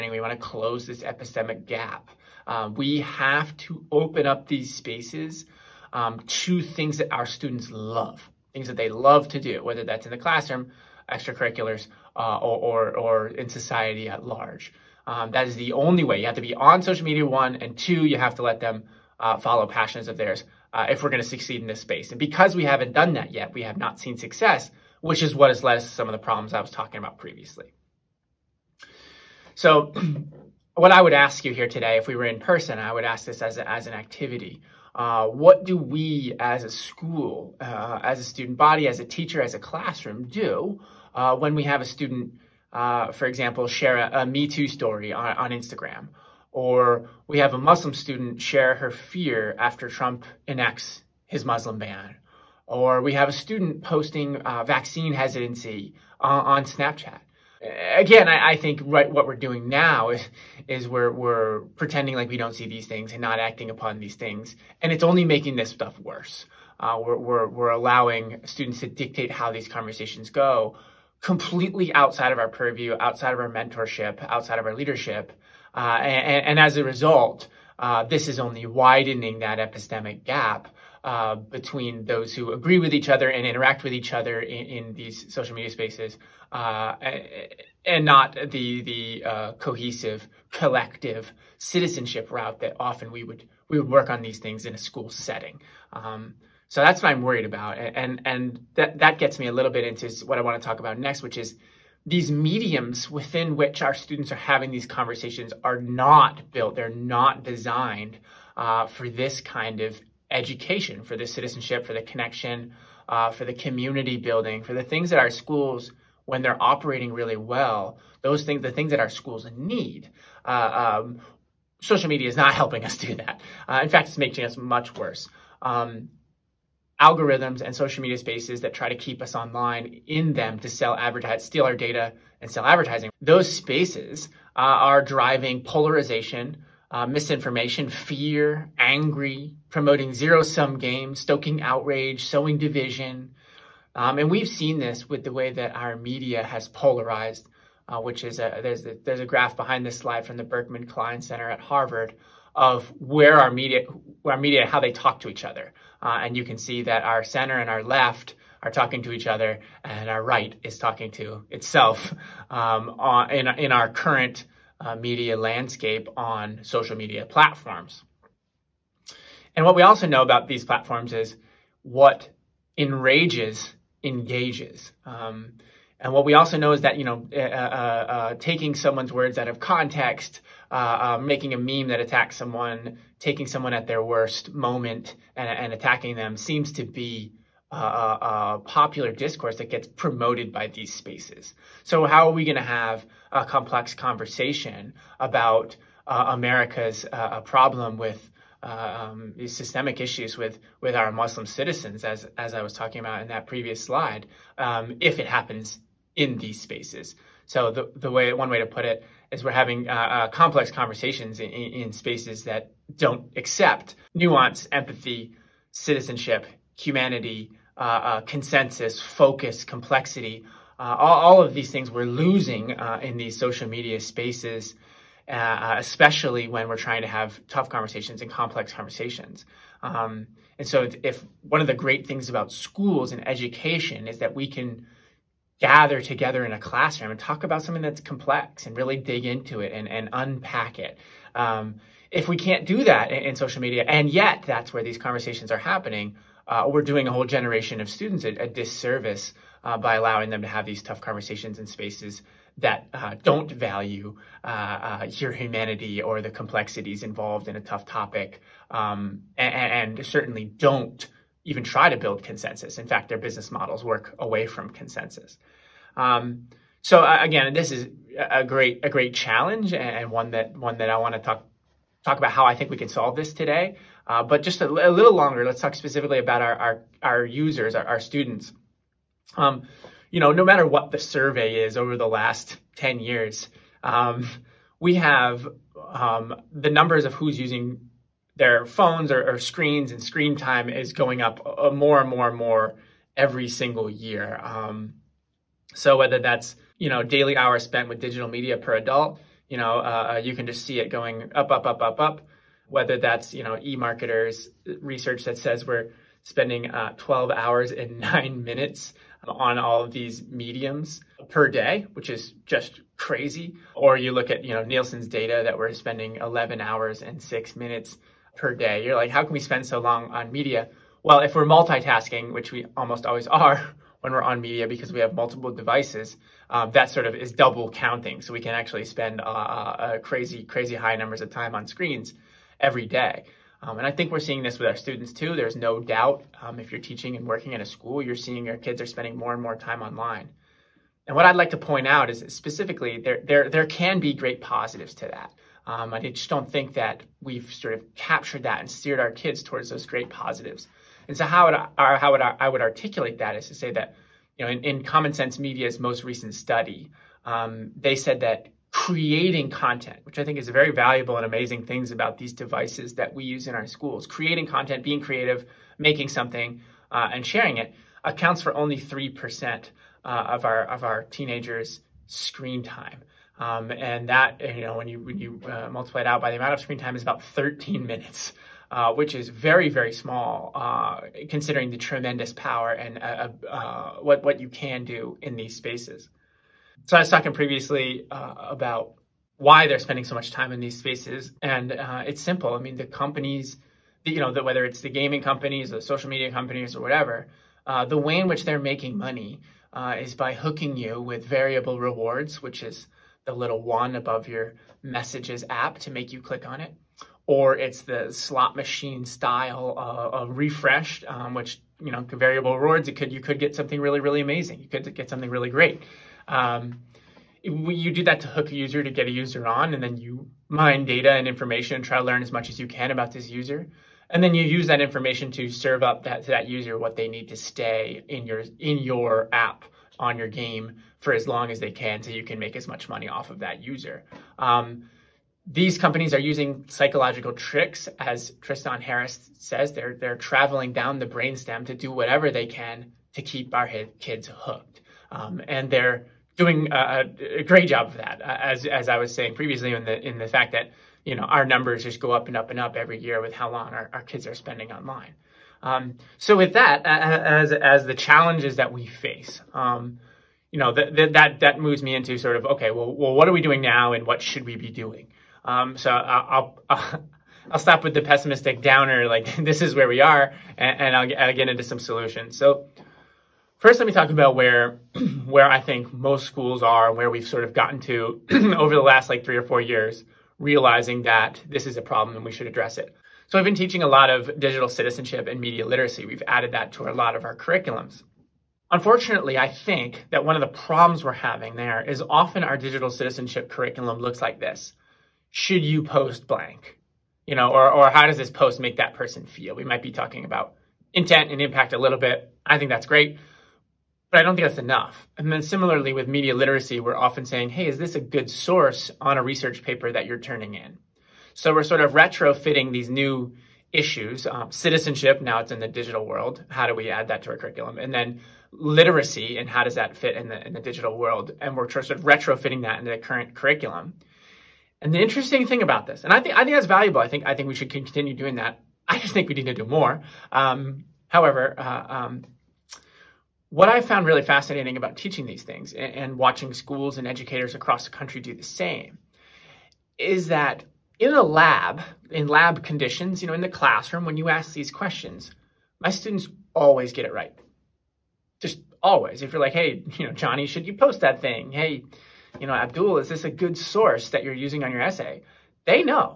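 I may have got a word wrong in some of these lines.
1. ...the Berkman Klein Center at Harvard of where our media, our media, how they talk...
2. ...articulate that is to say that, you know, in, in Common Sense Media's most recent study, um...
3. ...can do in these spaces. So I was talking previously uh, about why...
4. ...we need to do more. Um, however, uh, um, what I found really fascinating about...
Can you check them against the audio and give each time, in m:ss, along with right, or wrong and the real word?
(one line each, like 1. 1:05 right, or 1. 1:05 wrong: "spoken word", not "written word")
1. 2:30 right
2. 5:52 right
3. 6:24 right
4. 8:49 right.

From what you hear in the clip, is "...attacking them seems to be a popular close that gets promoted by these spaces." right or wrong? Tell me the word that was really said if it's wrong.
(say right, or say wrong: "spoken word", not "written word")
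wrong: "discourse", not "close".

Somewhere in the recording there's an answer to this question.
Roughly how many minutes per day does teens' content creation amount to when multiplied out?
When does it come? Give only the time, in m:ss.
6:17.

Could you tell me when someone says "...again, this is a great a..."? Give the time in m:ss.
4:27.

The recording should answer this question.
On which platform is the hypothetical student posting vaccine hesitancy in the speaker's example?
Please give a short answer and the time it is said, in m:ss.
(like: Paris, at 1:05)
Snapchat, at 0:56.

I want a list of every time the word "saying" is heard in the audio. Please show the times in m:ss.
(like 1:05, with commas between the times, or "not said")
7:29, 8:27.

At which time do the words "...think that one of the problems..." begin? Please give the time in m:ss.
8:09.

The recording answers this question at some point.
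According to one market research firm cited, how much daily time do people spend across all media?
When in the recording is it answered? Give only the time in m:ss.
5:06.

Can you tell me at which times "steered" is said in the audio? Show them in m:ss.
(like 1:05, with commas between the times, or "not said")
5:48.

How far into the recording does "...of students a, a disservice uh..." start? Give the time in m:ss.
4:07.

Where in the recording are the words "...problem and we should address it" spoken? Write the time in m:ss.
8:01.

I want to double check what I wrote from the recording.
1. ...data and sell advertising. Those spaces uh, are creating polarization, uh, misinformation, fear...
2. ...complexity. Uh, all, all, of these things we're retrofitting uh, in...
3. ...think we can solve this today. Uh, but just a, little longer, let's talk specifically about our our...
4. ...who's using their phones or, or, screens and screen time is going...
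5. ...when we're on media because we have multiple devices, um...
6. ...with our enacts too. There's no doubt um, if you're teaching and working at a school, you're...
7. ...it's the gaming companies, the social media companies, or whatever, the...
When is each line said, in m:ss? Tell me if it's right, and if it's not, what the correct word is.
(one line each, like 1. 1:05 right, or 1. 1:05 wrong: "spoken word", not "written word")
1. 2:11 wrong: "driving", not "creating"
2. 3:39 wrong: "losing", not "retrofitting"
3. 4:32 right
4. 4:47 right
5. 5:23 right
6. 5:34 wrong: "students", not "enacts"
7. 6:34 right.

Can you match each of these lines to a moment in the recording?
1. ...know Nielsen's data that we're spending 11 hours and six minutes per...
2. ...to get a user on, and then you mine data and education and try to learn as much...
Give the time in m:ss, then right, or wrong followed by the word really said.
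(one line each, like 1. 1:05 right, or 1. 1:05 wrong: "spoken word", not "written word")
1. 5:14 right
2. 6:58 wrong: "information", not "education".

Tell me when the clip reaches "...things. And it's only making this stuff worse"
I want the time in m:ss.
1:04.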